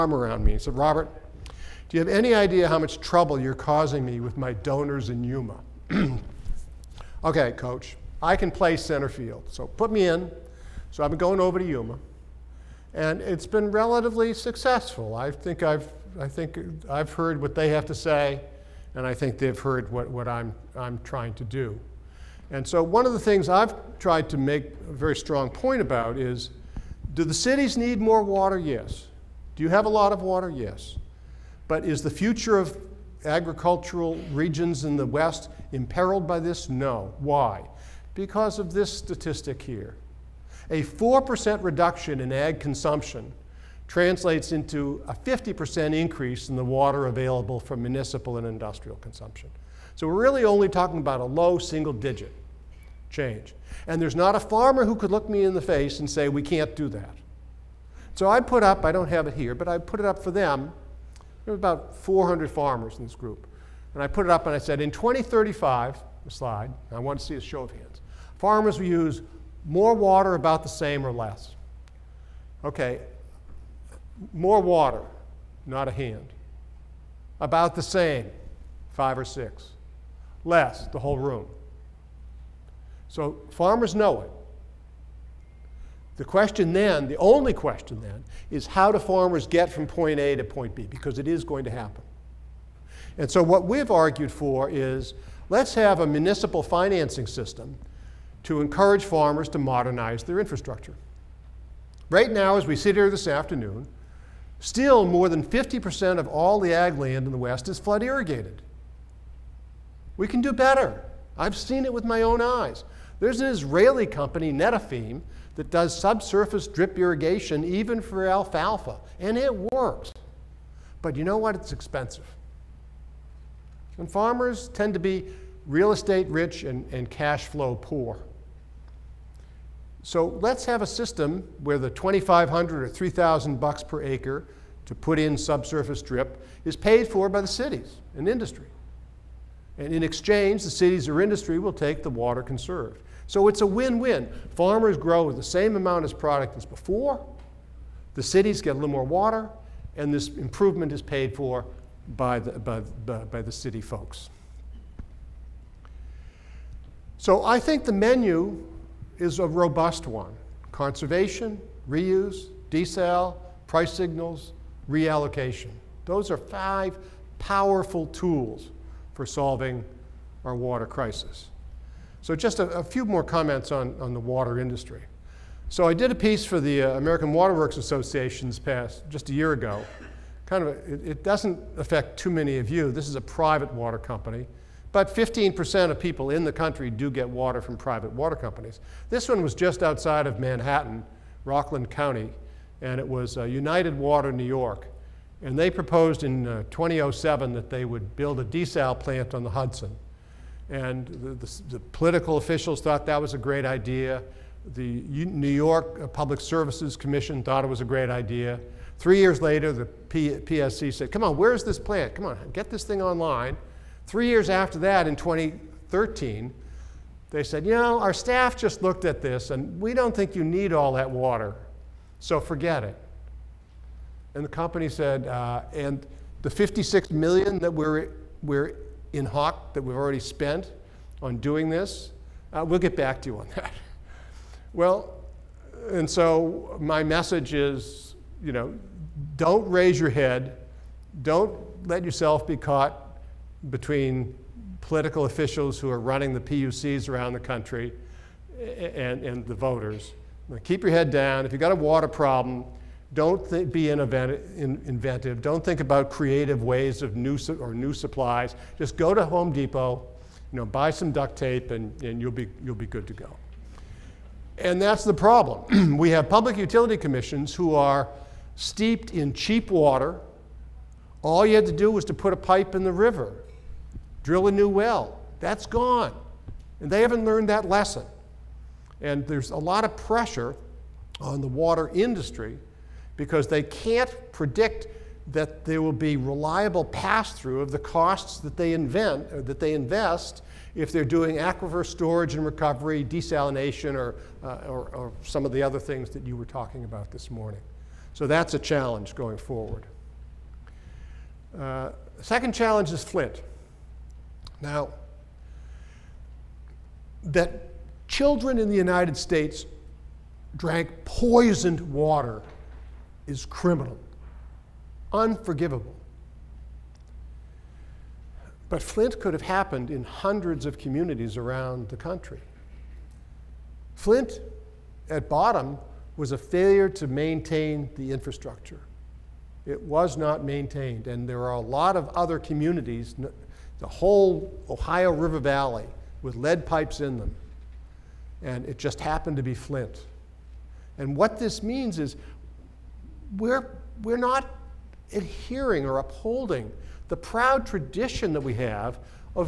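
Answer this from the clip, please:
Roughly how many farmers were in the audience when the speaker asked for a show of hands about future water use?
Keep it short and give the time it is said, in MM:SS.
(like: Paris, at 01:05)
400, at 01:01.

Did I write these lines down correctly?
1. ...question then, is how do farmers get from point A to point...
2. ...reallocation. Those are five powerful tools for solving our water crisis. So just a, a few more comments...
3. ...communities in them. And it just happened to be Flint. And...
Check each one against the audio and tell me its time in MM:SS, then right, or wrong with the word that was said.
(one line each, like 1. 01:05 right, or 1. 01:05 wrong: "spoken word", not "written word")
1. 01:27 right
2. 02:44 right
3. 05:36 wrong: "pipes", not "communities".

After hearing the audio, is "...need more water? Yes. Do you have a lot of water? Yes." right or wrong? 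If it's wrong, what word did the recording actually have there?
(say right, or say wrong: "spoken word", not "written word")
right.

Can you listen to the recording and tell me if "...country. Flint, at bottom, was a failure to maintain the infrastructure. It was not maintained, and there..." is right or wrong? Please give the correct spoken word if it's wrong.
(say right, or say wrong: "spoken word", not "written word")
right.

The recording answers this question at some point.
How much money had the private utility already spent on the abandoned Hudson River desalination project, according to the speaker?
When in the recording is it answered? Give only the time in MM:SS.
03:46.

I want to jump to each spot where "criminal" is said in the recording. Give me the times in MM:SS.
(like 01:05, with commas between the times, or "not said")
05:13.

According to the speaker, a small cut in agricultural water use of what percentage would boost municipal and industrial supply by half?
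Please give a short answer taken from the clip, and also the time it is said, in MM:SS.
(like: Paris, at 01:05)
4%, at 00:40.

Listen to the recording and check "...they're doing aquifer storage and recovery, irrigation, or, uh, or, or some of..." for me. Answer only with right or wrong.
wrong.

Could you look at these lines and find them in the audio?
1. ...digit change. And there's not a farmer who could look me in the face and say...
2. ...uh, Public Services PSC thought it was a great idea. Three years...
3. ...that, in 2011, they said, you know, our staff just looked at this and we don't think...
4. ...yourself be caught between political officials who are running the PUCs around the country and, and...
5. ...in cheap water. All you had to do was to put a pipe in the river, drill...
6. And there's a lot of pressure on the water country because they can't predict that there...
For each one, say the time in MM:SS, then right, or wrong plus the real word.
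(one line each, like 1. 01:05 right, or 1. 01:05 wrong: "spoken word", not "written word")
1. 00:51 right
2. 03:26 wrong: "Commission", not "PSC"
3. 03:34 wrong: "2013", not "2011"
4. 04:02 right
5. 04:29 right
6. 04:39 wrong: "industry", not "country".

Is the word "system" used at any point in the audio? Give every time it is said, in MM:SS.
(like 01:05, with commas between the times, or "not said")
01:37, 02:10.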